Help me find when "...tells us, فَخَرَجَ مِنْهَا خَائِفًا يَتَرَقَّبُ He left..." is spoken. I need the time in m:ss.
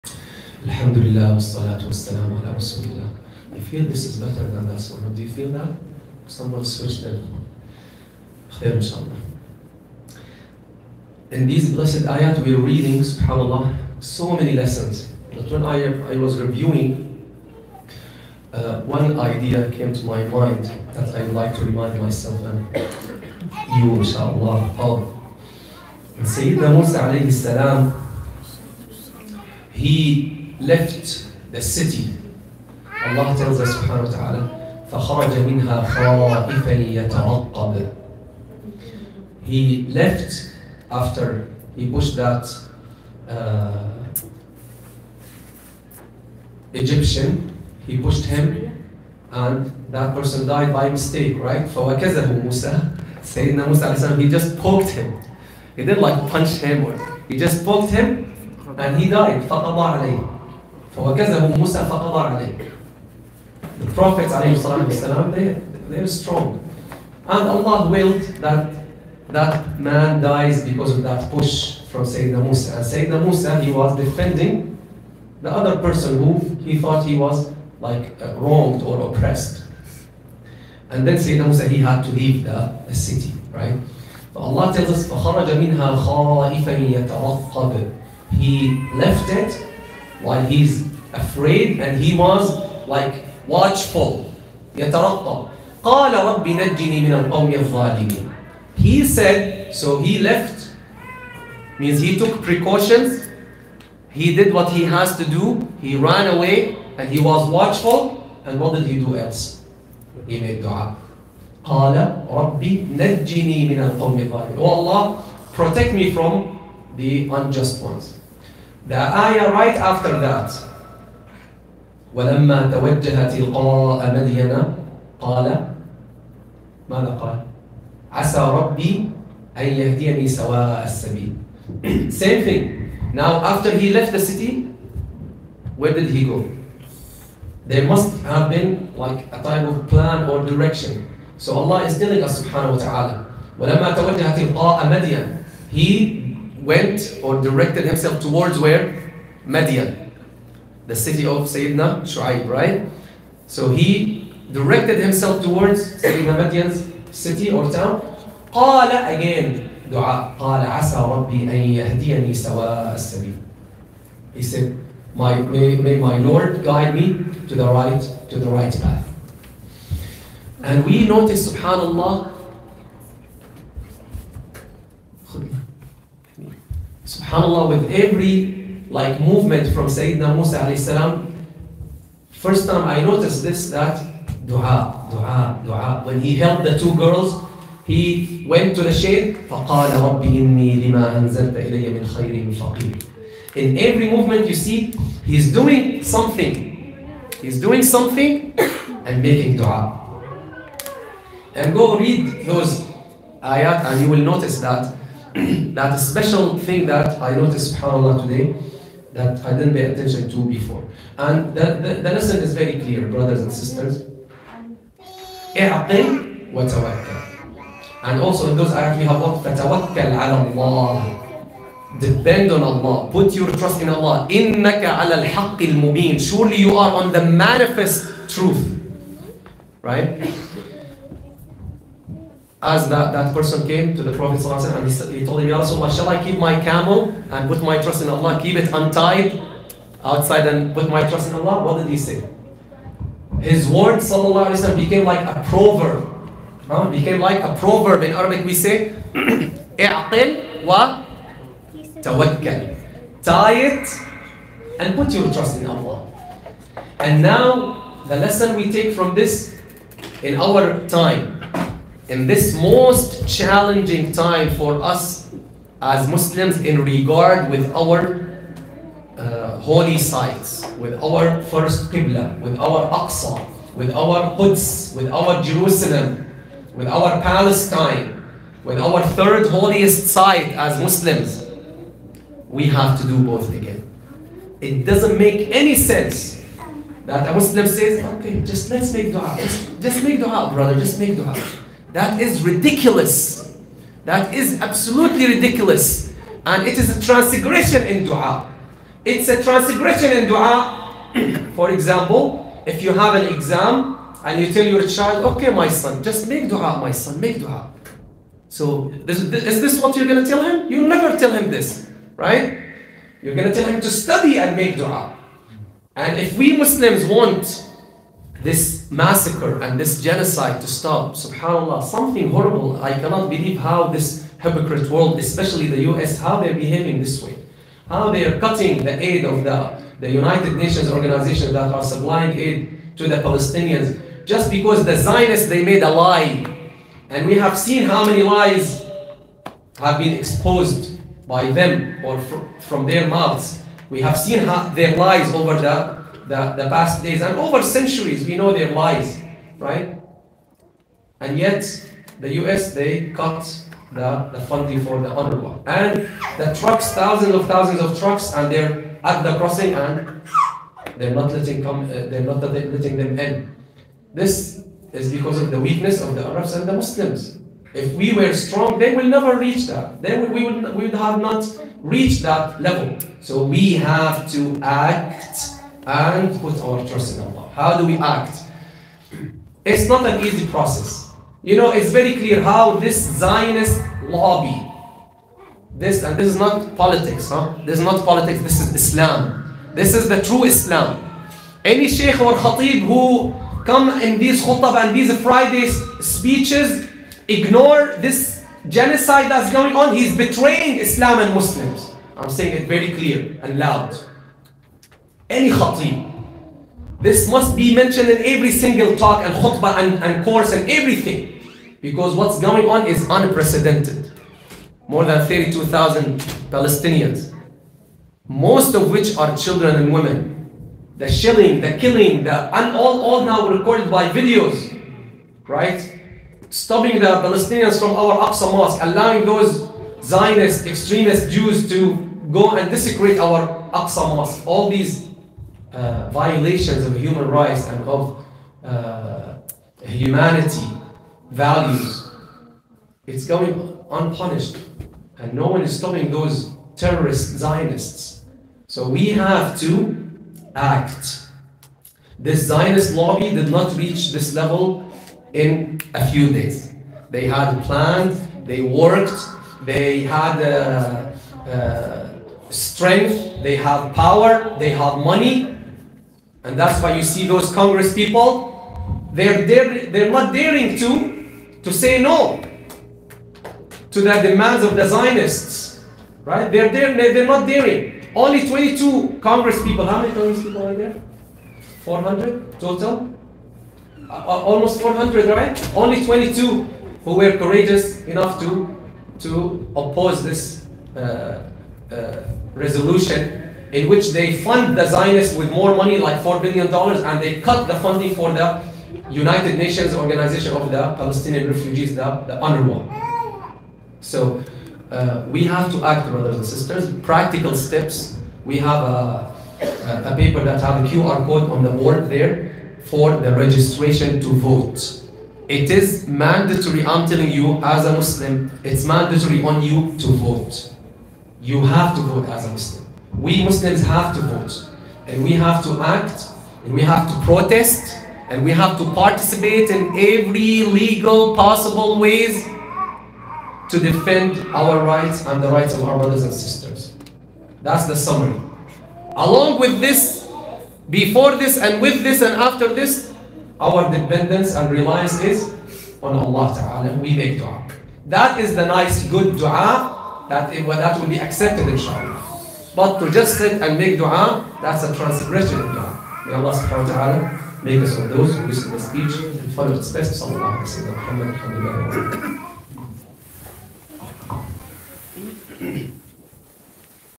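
1:24.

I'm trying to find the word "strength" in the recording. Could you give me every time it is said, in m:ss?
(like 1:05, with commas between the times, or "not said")
7:42.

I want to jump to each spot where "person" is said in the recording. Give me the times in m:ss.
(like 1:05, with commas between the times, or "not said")
0:50, 1:15, 3:53.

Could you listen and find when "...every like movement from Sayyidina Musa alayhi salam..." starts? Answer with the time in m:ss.
2:57.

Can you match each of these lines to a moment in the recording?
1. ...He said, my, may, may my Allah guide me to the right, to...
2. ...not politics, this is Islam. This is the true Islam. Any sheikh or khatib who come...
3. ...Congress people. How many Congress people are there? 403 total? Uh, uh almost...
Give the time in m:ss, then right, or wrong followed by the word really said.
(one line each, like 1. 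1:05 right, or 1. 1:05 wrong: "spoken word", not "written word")
1. 2:44 wrong: "Lord", not "Allah"
2. 6:27 right
3. 7:59 wrong: "400", not "403".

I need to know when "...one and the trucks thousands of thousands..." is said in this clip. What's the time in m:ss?
5:55.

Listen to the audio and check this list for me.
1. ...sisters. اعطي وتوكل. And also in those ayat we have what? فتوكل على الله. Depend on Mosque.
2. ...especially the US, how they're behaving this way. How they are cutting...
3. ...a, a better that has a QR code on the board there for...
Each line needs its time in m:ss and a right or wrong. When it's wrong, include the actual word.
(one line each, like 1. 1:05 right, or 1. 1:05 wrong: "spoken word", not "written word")
1. 3:33 wrong: "Allah", not "Mosque"
2. 5:25 right
3. 8:29 wrong: "paper", not "better".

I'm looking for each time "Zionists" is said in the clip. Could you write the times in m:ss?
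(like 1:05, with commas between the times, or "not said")
5:34, 6:23, 7:10, 7:27, 7:32, 7:54, 8:14.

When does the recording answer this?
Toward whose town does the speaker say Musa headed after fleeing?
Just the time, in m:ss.
2:31.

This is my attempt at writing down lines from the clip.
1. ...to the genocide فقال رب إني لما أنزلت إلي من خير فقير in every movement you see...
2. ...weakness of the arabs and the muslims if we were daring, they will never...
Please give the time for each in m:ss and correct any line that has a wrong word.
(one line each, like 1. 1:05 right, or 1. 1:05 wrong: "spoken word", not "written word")
1. 3:08 wrong: "shade", not "genocide"
2. 6:05 wrong: "strong", not "daring".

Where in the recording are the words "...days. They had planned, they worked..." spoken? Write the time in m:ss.
7:36.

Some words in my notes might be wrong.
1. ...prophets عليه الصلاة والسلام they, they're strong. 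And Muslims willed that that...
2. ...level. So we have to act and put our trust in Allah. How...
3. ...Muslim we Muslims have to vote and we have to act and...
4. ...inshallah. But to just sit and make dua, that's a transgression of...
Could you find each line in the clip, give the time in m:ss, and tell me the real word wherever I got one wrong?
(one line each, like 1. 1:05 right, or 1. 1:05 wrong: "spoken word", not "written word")
1. 1:03 wrong: "Allah", not "Muslims"
2. 6:12 right
3. 8:42 right
4. 9:11 right.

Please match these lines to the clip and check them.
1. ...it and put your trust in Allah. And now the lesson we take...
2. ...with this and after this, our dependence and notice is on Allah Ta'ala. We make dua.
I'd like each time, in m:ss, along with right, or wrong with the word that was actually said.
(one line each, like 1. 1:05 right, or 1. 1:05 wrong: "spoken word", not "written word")
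1. 4:13 right
2. 9:01 wrong: "reliance", not "notice".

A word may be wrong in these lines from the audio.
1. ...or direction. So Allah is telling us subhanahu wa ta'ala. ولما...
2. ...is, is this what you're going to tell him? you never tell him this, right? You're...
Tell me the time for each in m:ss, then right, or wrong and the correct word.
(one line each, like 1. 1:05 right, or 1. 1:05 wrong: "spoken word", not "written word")
1. 2:20 right
2. 5:09 right.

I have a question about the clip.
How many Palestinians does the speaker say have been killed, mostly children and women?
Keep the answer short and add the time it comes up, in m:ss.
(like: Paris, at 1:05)
32,000, at 6:55.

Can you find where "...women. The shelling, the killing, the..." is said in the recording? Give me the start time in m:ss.
6:59.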